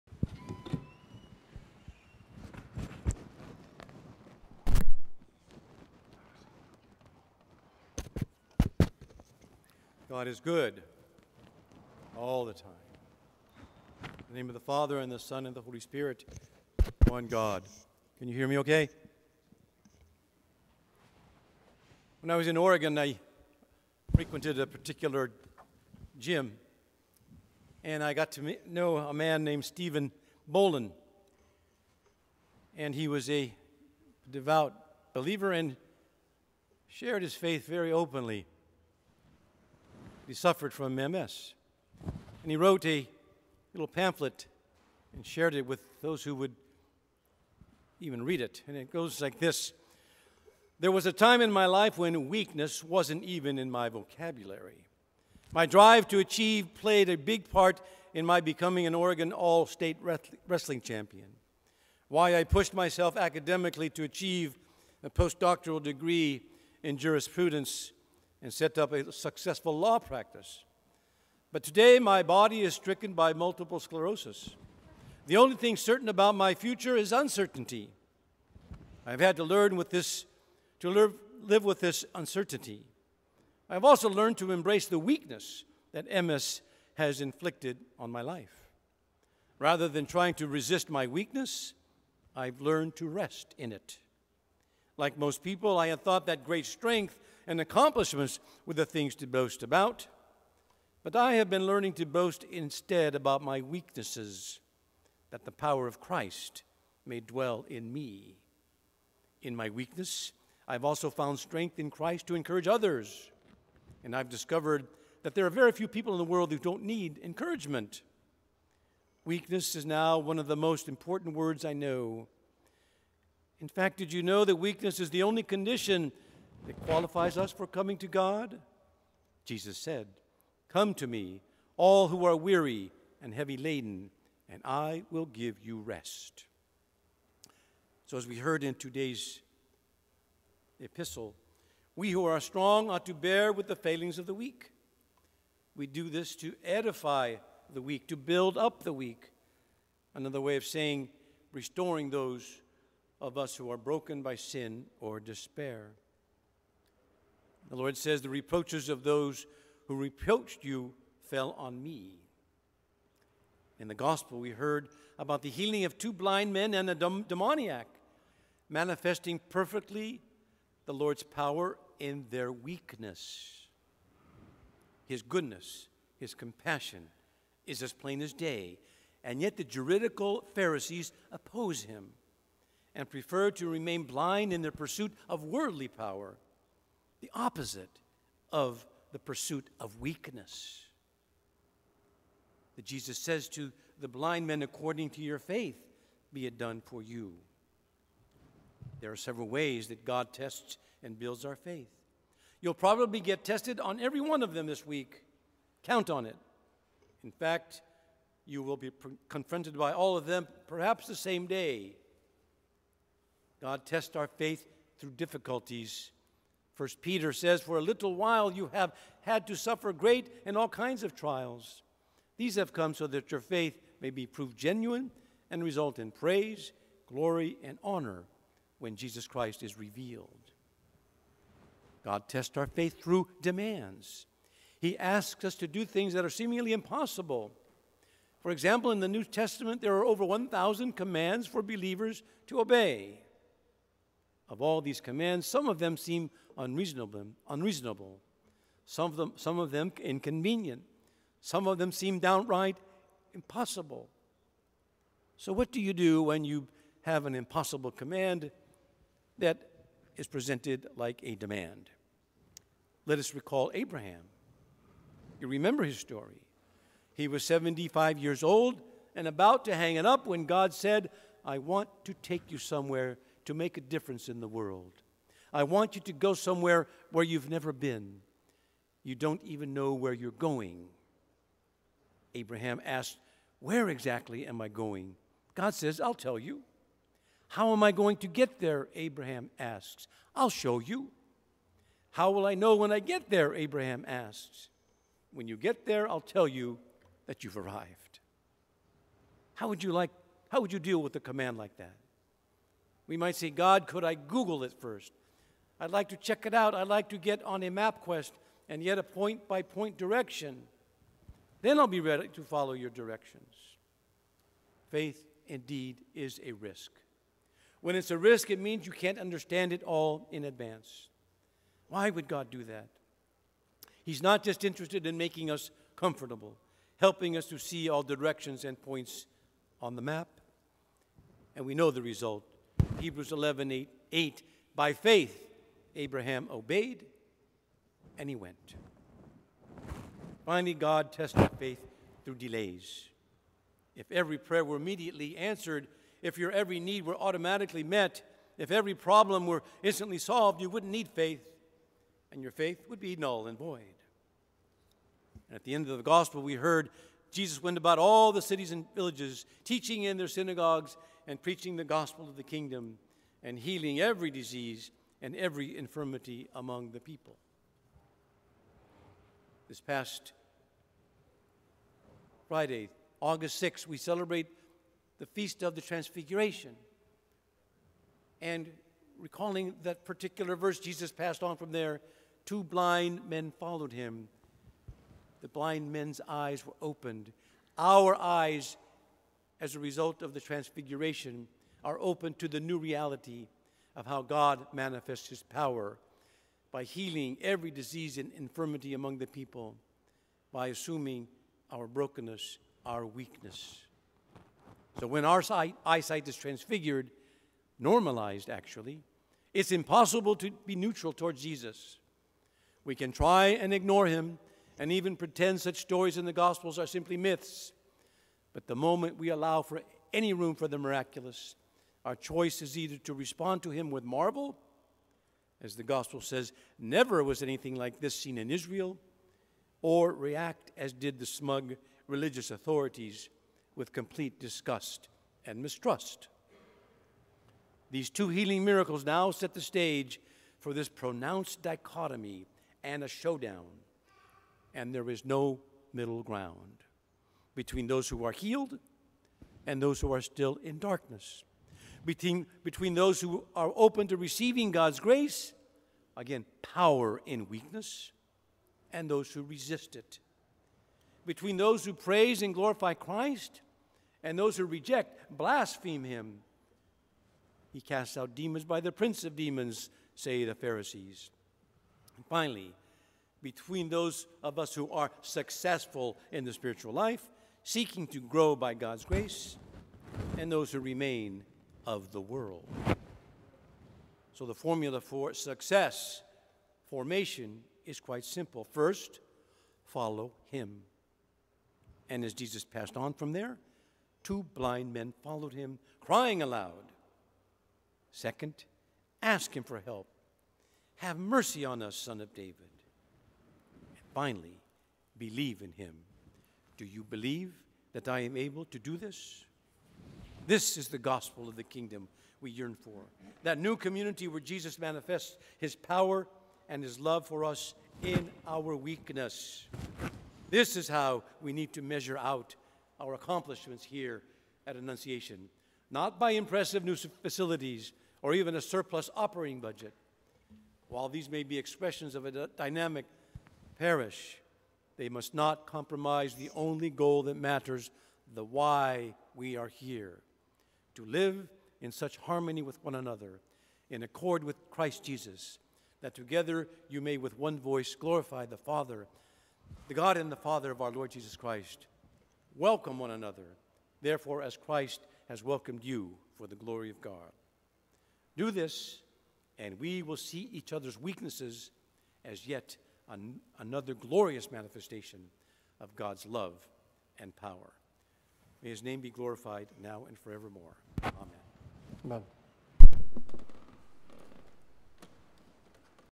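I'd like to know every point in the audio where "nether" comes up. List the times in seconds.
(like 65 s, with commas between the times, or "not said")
not said.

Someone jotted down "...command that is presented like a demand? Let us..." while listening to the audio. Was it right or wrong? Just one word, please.
right.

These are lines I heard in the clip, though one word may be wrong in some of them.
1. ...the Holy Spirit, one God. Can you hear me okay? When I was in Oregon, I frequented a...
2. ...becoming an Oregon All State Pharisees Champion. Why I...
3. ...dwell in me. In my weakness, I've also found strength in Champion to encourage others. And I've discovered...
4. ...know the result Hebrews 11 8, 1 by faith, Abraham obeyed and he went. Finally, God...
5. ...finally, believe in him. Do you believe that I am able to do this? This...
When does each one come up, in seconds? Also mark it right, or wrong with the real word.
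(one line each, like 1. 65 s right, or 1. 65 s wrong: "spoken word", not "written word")
1. 15 s right
2. 58 s wrong: "Wrestling", not "Pharisees"
3. 107 s wrong: "Christ", not "Champion"
4. 331 s wrong: "8", not "1"
5. 504 s right.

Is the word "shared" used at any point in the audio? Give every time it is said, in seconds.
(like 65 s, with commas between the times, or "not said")
36 s, 45 s.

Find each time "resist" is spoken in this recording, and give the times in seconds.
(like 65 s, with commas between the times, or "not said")
90 s, 459 s.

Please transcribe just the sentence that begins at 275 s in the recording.
I want you to go somewhere where you've never been.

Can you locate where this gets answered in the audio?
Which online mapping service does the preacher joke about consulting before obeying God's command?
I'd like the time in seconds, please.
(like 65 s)
307 s.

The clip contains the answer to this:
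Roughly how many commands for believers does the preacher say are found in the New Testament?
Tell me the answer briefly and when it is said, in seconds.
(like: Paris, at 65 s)
Over 1,000, at 240 s.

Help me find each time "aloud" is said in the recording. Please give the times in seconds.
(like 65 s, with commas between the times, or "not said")
496 s.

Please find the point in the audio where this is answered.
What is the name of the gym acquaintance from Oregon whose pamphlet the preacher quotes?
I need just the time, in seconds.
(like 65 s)
29 s.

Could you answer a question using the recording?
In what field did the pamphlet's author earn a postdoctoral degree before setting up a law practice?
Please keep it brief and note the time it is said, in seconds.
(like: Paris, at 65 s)
Jurisprudence, at 66 s.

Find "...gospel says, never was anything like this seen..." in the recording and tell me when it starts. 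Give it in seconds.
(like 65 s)
425 s.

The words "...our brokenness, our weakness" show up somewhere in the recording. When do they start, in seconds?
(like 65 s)
401 s.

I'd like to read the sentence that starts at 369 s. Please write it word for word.
This past Friday, August 6th, we celebrate the Feast of the Transfiguration.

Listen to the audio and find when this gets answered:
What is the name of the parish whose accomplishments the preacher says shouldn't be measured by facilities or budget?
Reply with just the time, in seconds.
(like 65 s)
524 s.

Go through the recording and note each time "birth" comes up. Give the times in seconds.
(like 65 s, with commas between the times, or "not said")
not said.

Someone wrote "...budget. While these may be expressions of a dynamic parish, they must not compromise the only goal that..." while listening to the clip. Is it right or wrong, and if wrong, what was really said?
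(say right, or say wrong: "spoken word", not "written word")
right.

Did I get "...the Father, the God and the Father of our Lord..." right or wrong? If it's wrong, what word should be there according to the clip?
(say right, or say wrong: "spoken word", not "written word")
right.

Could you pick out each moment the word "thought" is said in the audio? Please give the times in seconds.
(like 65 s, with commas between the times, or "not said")
96 s.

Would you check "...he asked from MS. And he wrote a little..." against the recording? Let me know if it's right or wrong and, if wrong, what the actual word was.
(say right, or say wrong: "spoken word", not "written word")
wrong: "suffered", not "asked".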